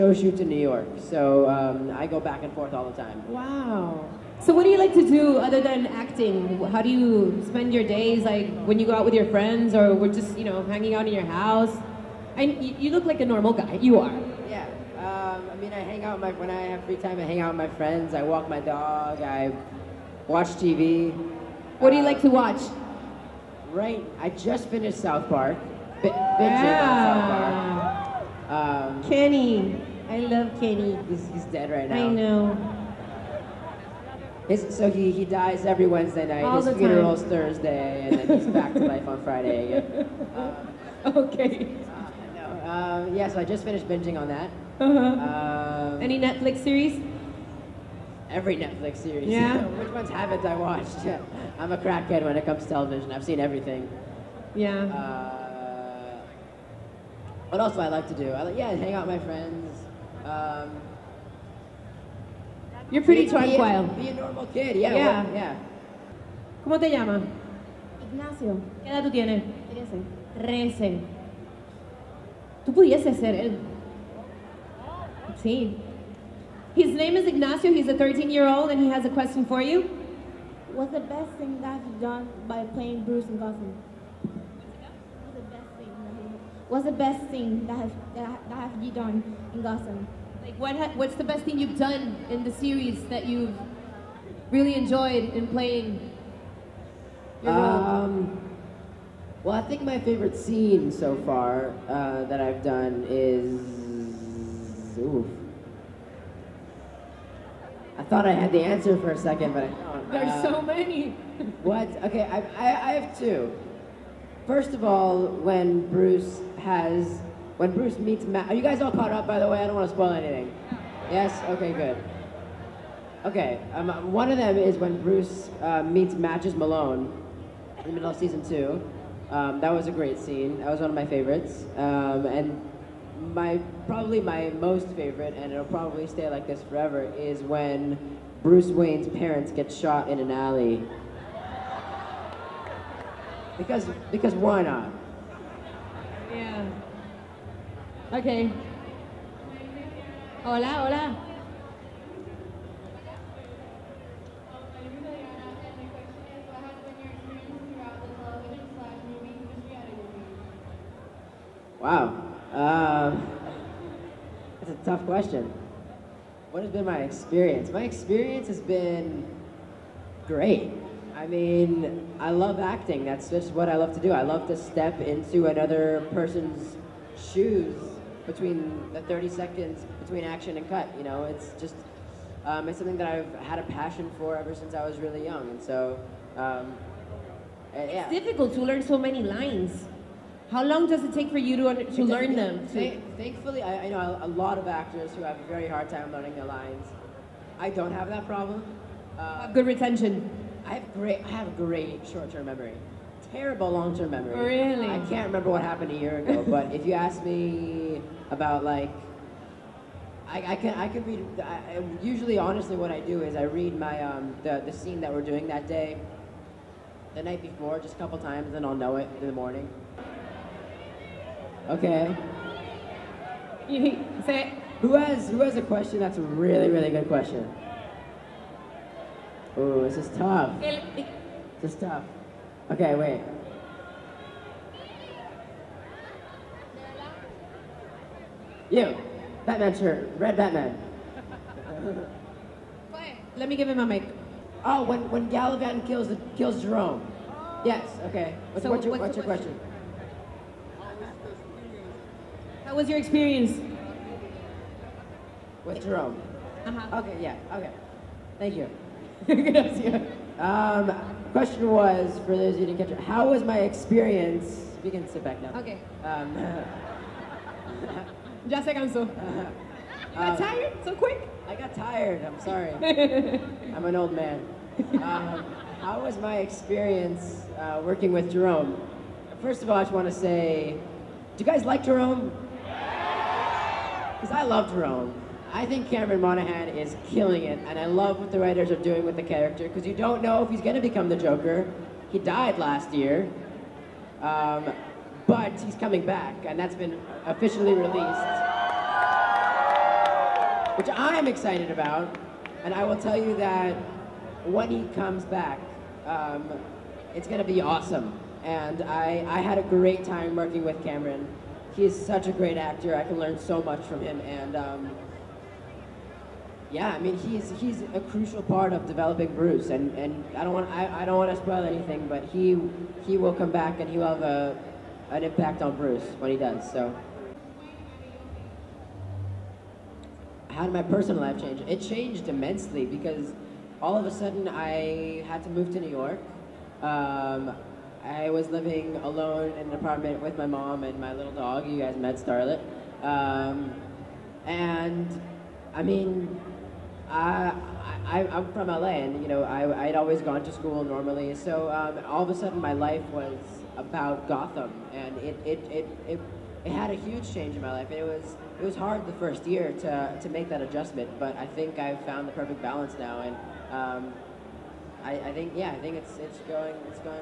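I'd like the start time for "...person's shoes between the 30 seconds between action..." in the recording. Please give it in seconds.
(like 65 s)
176 s.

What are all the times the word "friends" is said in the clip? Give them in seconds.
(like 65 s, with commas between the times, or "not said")
9 s, 17 s, 59 s.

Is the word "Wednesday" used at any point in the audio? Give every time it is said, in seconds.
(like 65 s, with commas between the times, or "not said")
35 s.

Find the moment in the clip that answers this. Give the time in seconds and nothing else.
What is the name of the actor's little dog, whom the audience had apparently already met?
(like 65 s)
342 s.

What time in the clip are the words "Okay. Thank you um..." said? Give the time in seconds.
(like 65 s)
257 s.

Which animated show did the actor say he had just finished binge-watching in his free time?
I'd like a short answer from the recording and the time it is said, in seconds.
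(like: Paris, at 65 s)
South Park, at 24 s.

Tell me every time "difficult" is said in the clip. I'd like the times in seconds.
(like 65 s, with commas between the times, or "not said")
188 s.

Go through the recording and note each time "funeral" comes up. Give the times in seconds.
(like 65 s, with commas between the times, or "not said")
36 s.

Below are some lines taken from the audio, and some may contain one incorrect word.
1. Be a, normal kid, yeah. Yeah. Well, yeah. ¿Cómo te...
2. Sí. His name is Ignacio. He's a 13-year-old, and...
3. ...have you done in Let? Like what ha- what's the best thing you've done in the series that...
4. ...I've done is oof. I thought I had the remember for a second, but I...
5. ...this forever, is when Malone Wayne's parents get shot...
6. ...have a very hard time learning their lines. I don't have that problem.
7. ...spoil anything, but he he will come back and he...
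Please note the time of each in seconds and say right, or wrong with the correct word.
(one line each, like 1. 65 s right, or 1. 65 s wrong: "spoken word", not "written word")
1. 63 s right
2. 75 s right
3. 88 s wrong: "Gotham", not "Let"
4. 102 s wrong: "answer", not "remember"
5. 136 s wrong: "Bruce", not "Malone"
6. 195 s right
7. 321 s right.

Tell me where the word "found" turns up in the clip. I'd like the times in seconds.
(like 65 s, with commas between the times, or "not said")
362 s.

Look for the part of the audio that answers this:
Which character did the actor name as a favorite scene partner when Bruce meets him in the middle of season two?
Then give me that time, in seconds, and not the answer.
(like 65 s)
126 s.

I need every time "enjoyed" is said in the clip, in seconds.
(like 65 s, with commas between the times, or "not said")
94 s.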